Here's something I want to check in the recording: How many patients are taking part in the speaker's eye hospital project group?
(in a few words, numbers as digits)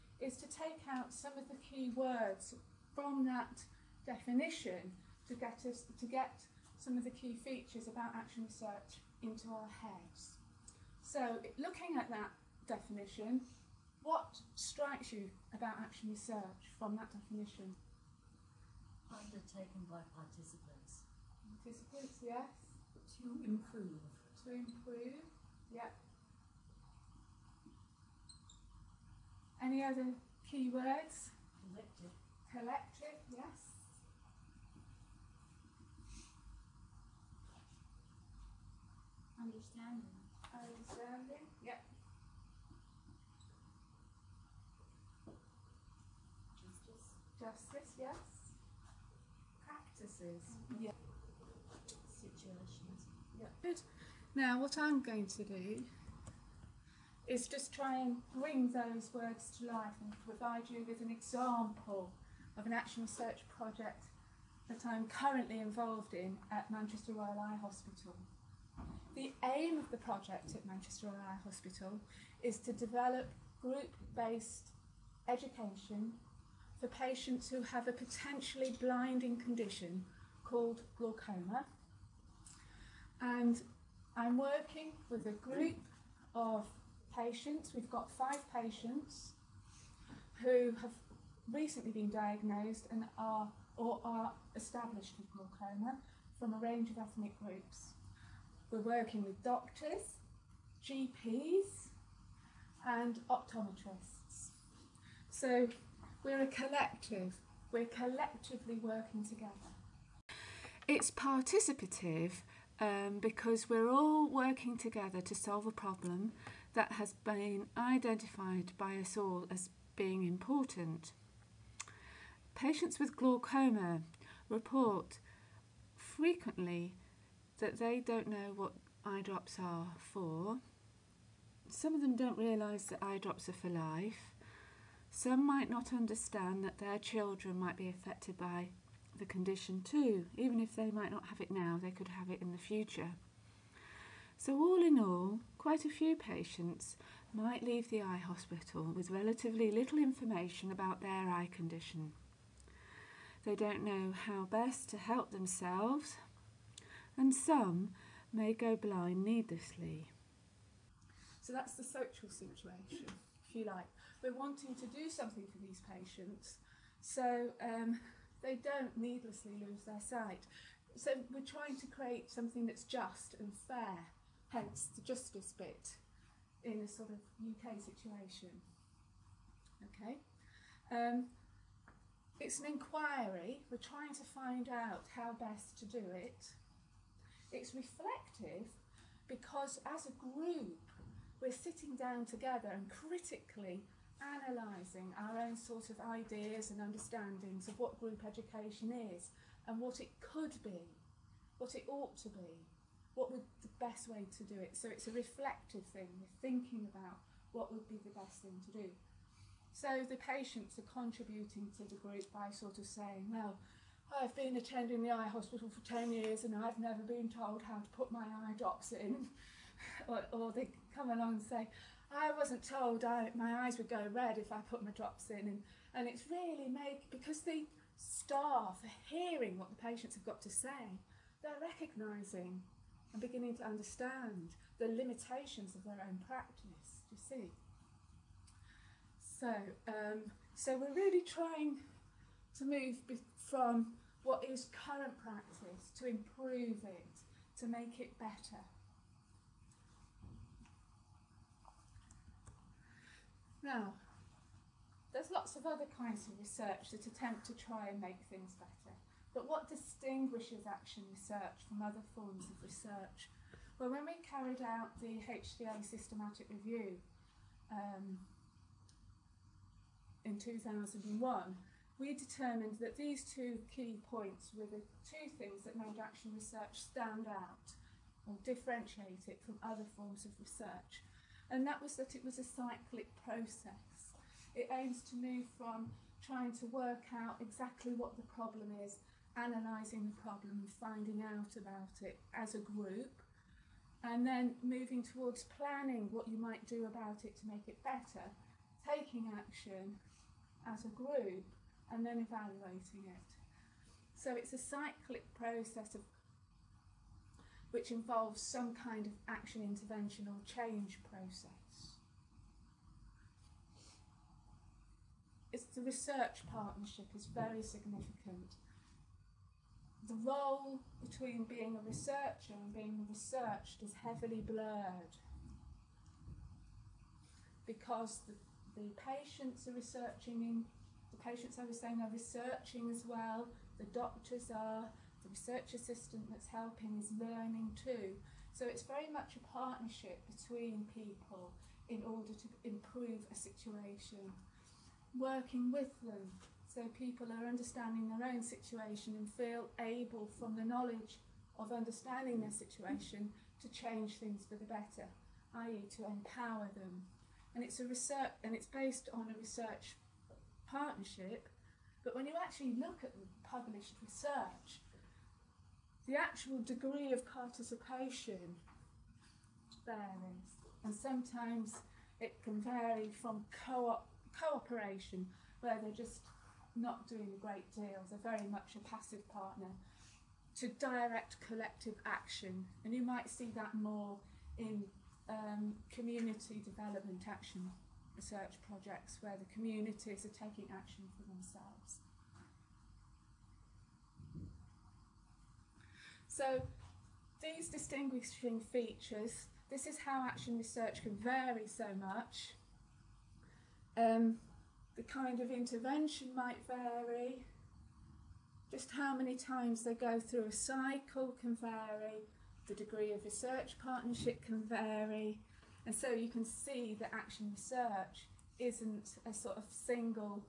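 5.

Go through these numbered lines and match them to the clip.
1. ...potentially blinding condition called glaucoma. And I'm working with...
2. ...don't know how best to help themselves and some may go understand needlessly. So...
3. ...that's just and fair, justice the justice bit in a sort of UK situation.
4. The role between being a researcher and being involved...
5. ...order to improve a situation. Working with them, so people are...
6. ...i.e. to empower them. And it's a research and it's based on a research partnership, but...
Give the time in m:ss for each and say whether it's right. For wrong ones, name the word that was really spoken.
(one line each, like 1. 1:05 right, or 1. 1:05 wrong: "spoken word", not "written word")
1. 1:17 right
2. 2:33 wrong: "blind", not "understand"
3. 2:52 wrong: "hence", not "justice"
4. 5:20 wrong: "researched", not "involved"
5. 5:42 right
6. 5:55 right.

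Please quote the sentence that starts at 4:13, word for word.
Now, there's lots of other kinds of research that attempt to try and make things better.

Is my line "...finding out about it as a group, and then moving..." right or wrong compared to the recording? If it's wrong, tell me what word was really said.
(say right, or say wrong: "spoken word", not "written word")
right.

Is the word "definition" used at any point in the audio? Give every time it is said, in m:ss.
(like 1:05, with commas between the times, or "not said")
0:04, 0:12, 0:17.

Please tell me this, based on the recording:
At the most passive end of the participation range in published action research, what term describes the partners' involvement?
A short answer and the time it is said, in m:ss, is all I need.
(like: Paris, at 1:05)
cooperation, at 6:14.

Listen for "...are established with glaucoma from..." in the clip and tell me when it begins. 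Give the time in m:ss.
1:34.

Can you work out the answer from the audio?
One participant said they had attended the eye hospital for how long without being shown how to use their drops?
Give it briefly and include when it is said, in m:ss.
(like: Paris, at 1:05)
10 years, at 3:35.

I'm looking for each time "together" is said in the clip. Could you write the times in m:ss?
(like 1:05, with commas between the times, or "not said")
1:49, 1:54, 3:12.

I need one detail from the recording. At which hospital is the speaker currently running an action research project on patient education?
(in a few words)
Manchester Royal Eye Hospital.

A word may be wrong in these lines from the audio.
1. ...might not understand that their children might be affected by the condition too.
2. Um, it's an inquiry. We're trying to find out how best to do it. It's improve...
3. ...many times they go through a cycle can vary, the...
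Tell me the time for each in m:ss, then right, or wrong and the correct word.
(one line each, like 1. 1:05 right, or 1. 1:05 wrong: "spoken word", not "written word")
1. 2:15 right
2. 3:00 wrong: "reflective", not "improve"
3. 6:49 right.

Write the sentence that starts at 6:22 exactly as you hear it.
And you might see that more in um, community development action research projects where the communities are taking action for themselves.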